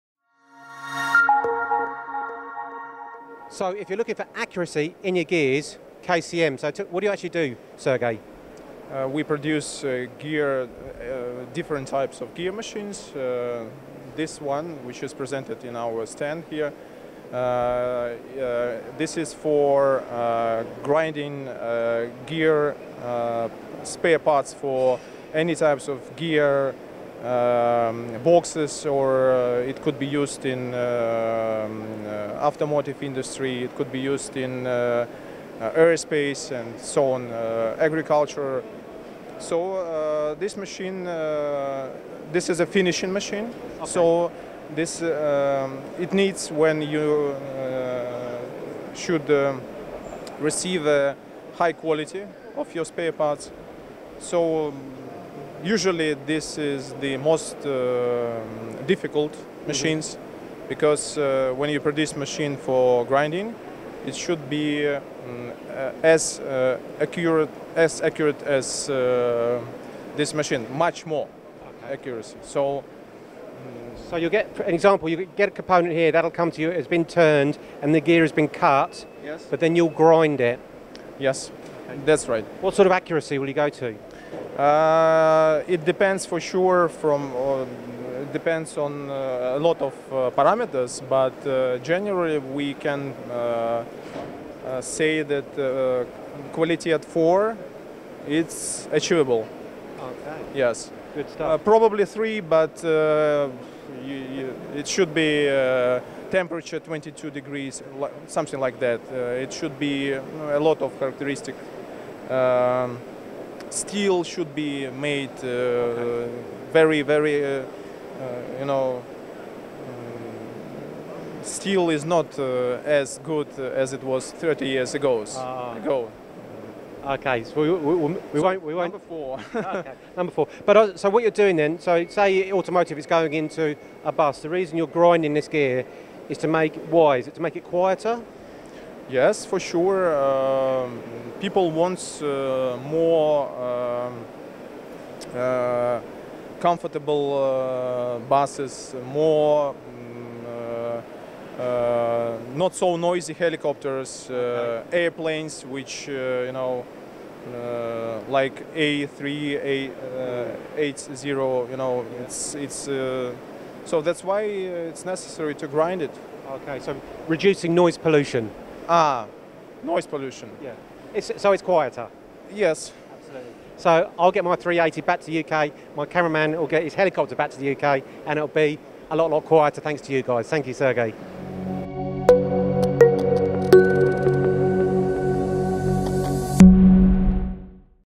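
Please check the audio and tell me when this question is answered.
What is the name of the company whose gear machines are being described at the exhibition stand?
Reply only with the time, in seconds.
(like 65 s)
6 s.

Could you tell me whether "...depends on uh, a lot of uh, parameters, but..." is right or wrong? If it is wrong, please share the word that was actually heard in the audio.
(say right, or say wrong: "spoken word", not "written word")
right.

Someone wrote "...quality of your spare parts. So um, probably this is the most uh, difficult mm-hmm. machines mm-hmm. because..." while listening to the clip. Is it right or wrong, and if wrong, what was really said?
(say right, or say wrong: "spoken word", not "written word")
wrong: "usually", not "probably".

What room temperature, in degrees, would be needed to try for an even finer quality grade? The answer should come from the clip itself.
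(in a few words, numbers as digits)
22.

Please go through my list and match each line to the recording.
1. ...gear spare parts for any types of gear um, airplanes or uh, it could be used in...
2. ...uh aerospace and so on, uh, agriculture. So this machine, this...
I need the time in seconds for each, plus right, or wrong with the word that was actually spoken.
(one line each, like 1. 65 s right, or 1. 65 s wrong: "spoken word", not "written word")
1. 22 s wrong: "boxes", not "airplanes"
2. 35 s right.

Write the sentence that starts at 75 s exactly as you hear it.
You get a component here that'll come to you.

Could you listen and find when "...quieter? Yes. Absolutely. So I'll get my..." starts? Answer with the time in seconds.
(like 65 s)
171 s.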